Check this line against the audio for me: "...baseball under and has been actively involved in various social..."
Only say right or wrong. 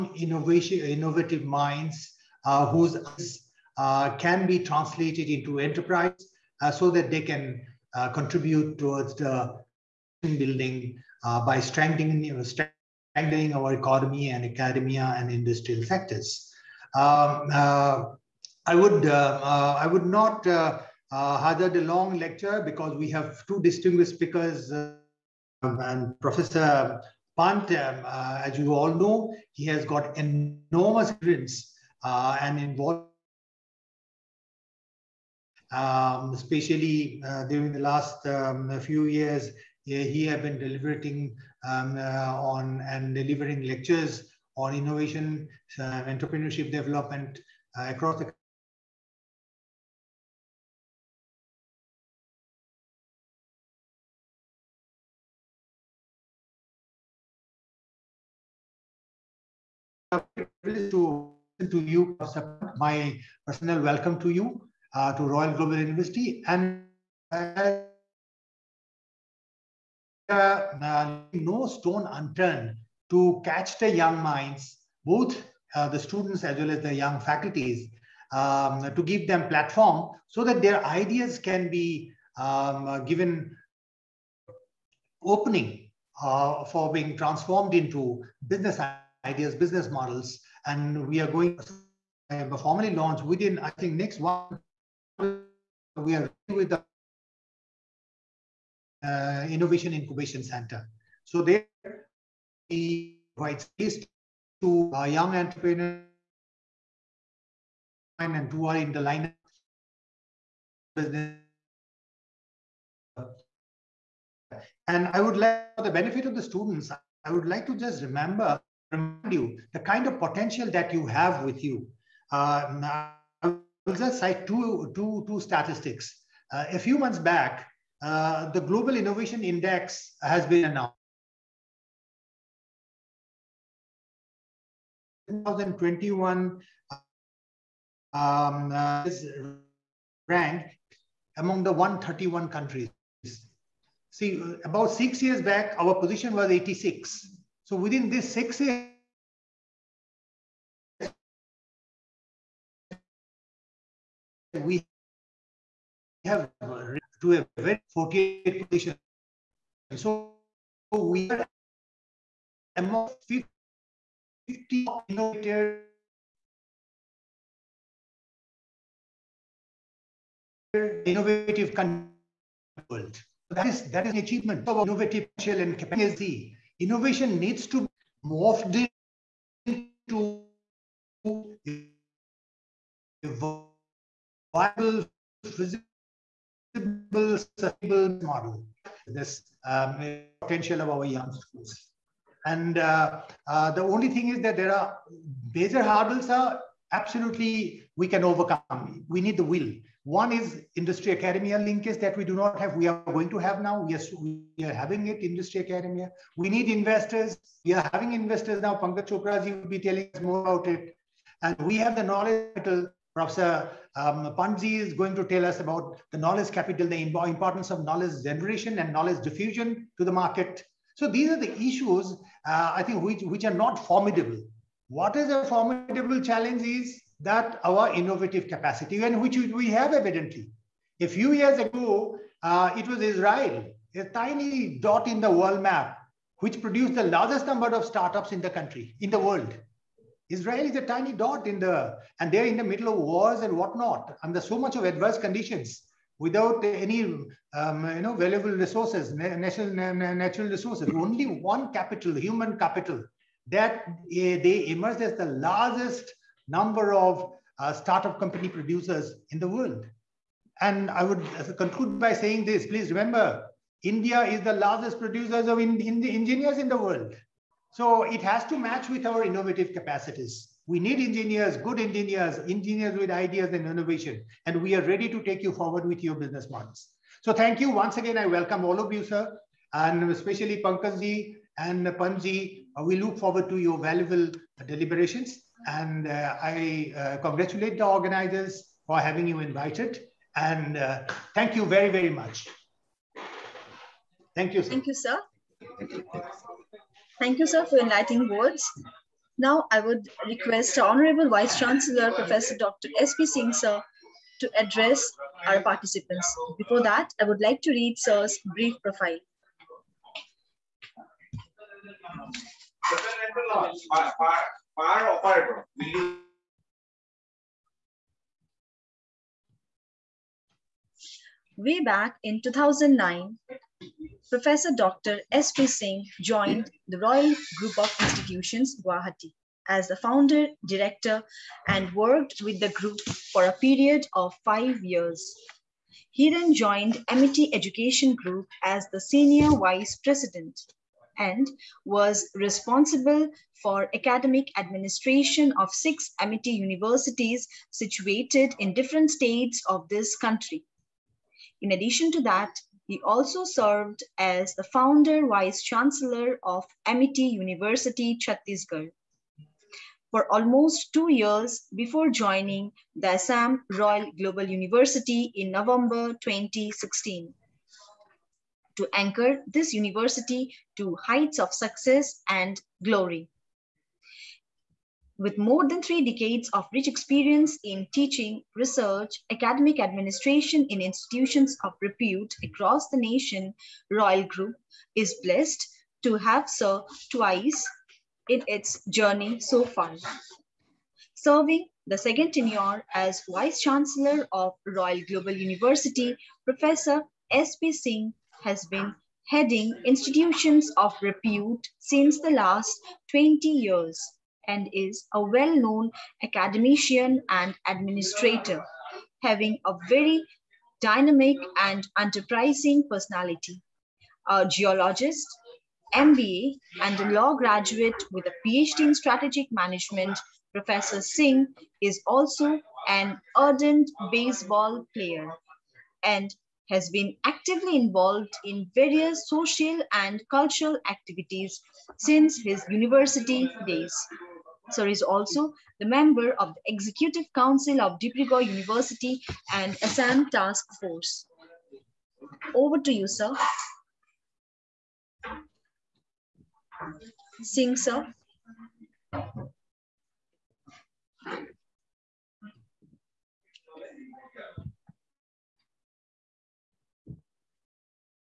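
wrong.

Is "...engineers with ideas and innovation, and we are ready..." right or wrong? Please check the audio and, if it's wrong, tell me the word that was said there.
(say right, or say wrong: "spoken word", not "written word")
right.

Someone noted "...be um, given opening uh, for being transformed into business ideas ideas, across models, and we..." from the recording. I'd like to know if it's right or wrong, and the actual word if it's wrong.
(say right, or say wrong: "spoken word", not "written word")
wrong: "business", not "across".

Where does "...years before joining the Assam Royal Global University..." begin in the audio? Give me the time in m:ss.
6:01.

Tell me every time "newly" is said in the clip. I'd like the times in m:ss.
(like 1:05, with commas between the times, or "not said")
not said.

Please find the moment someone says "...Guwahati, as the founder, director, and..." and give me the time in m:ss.
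5:28.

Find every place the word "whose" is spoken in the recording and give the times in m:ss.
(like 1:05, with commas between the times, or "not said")
0:02.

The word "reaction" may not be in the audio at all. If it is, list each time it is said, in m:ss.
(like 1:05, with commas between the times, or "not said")
not said.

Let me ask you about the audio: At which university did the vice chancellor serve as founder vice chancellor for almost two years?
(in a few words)
Amity University, Chhattisgarh.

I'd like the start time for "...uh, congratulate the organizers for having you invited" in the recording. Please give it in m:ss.
4:46.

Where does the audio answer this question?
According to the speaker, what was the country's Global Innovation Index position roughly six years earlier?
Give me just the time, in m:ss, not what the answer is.
2:25.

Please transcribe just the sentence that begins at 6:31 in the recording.
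Serving the second tenure as Vice Chancellor of Royal Global University, Professor S.P.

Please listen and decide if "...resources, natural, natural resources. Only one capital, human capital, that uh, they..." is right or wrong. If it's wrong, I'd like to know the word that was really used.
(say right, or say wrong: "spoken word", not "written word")
right.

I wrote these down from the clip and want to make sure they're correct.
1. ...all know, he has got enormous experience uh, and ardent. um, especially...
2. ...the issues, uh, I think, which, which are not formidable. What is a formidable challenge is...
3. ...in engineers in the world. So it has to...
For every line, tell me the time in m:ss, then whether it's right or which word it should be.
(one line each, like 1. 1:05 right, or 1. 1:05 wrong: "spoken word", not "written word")
1. 0:28 wrong: "involvement", not "ardent"
2. 3:41 right
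3. 4:25 right.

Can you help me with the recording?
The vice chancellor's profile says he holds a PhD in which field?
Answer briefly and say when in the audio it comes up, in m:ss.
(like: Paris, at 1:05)
strategic management, at 6:58.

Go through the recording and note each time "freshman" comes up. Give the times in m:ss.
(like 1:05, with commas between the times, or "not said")
not said.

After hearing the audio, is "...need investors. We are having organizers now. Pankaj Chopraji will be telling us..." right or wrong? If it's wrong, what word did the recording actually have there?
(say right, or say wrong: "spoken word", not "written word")
wrong: "investors", not "organizers".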